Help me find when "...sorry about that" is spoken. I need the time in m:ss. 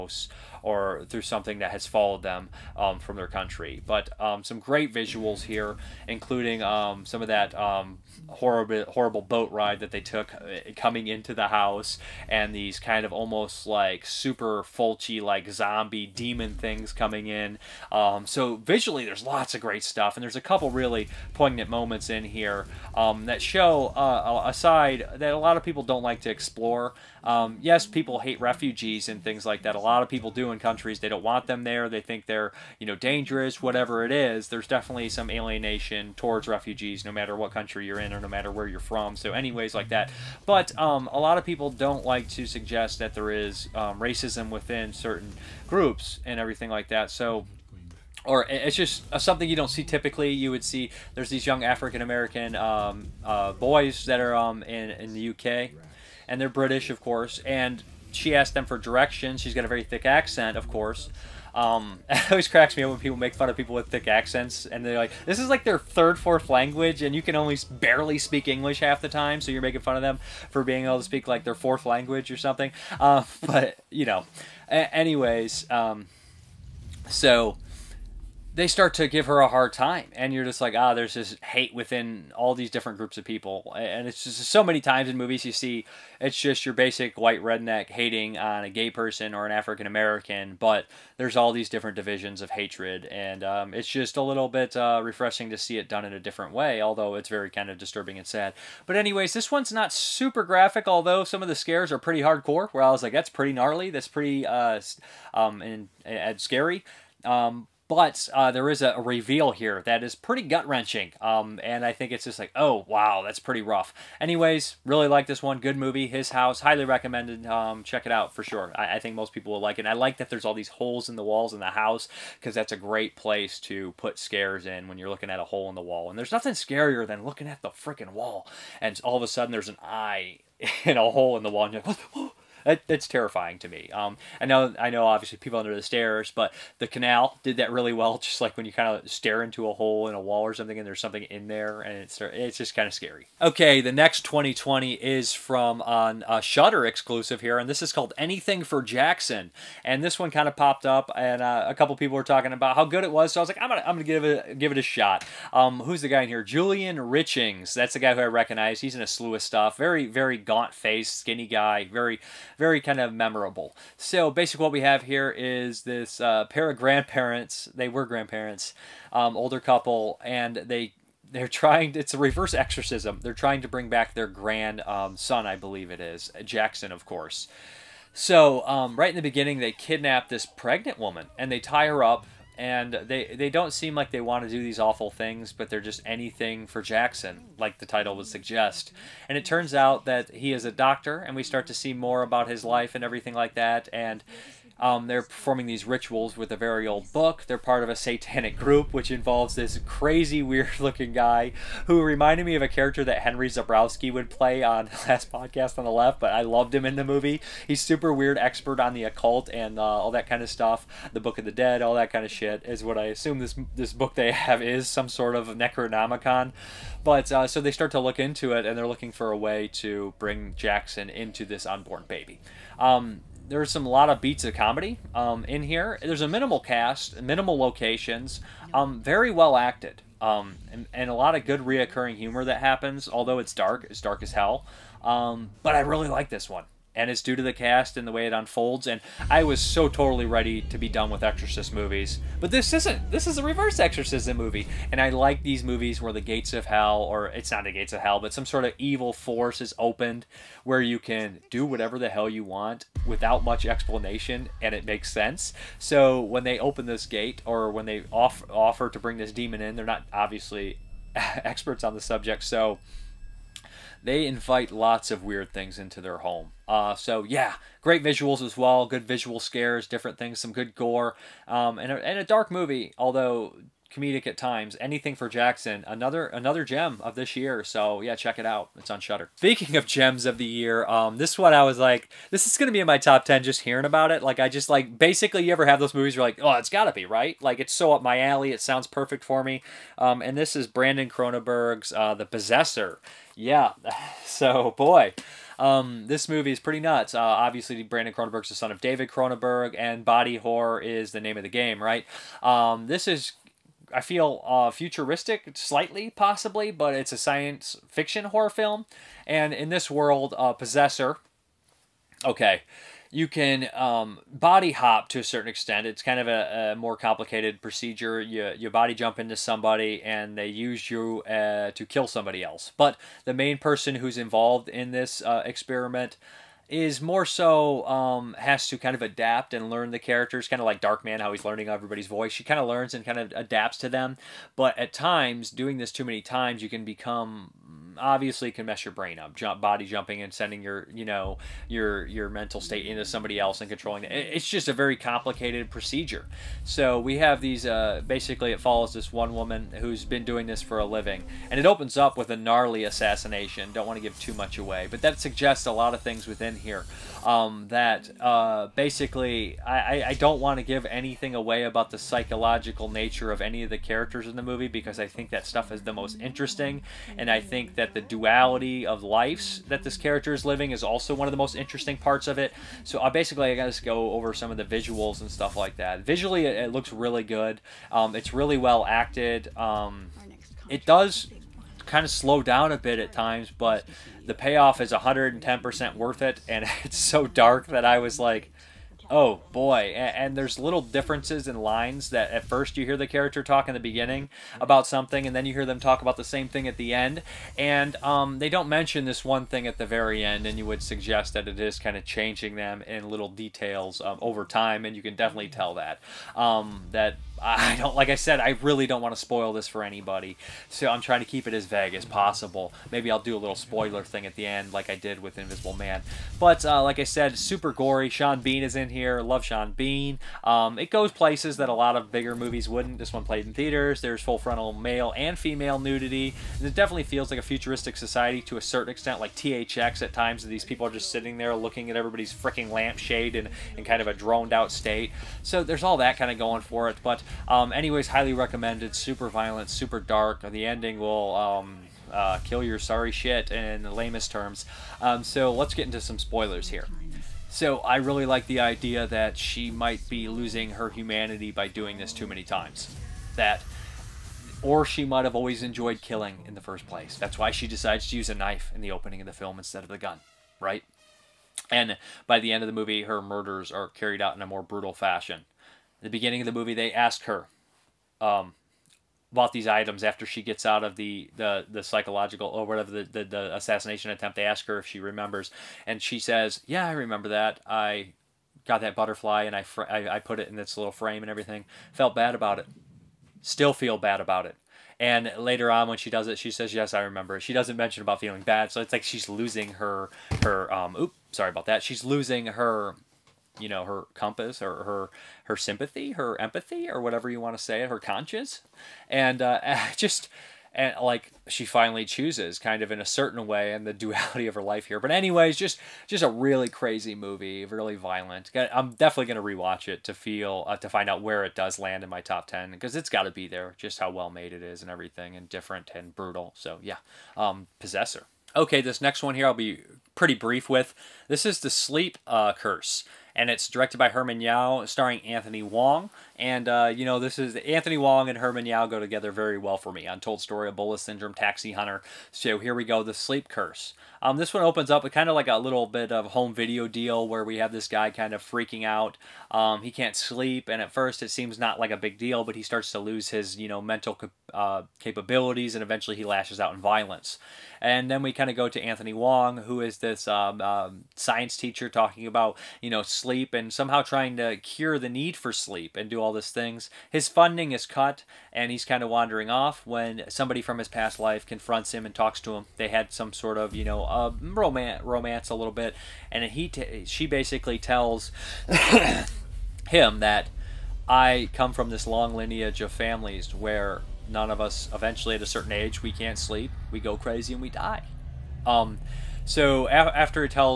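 8:11.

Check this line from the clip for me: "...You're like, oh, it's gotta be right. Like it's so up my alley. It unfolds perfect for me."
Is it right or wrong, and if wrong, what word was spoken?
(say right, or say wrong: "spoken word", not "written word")
wrong: "sounds", not "unfolds".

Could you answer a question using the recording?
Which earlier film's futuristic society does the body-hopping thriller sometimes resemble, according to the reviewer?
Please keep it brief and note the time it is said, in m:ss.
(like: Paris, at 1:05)
THX, at 7:09.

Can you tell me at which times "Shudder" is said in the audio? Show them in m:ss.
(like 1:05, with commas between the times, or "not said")
2:26, 4:38.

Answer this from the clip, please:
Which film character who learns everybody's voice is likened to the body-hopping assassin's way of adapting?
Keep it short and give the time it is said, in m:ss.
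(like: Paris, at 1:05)
Darkman, at 5:30.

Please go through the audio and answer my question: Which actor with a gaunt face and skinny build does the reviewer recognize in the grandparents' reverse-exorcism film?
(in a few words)
Julian Richings.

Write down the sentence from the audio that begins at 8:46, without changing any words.
And, uh, you know, this is Anthony Wong and Herman Yau go together very well for me.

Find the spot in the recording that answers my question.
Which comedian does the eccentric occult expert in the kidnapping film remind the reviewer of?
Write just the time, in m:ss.
3:23.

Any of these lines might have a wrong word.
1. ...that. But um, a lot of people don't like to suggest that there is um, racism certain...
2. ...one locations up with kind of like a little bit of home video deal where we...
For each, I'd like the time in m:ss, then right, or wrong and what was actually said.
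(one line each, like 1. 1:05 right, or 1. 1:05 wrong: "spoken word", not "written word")
1. 0:39 wrong: "within", not "certain"
2. 8:54 wrong: "opens", not "locations".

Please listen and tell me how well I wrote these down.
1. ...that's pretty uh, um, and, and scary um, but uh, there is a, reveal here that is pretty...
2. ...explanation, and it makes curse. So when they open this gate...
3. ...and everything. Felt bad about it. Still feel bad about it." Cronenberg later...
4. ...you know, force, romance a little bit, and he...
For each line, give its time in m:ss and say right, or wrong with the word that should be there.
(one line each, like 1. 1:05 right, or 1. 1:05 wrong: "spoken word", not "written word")
1. 1:43 right
2. 4:13 wrong: "sense", not "curse"
3. 8:01 wrong: "And", not "Cronenberg"
4. 9:23 wrong: "romance", not "force".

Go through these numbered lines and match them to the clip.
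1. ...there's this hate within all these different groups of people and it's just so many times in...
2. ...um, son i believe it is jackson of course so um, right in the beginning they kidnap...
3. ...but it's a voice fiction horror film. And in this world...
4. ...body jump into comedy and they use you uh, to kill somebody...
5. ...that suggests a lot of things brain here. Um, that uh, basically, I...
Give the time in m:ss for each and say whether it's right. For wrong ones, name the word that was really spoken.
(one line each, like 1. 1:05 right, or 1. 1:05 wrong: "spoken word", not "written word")
1. 1:20 right
2. 2:54 right
3. 5:06 wrong: "science", not "voice"
4. 5:18 wrong: "somebody", not "comedy"
5. 5:55 wrong: "within", not "brain".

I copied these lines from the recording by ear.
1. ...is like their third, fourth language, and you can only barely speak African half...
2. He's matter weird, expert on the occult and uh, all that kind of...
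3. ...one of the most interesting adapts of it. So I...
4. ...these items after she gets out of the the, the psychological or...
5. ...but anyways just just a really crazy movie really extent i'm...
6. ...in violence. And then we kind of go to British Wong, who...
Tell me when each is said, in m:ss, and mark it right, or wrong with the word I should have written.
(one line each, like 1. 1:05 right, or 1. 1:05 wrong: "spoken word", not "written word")
1. 1:05 wrong: "English", not "African"
2. 3:27 wrong: "super", not "matter"
3. 6:11 wrong: "parts", not "adapts"
4. 7:49 right
5. 8:24 wrong: "violent", not "extent"
6. 9:06 wrong: "Anthony", not "British".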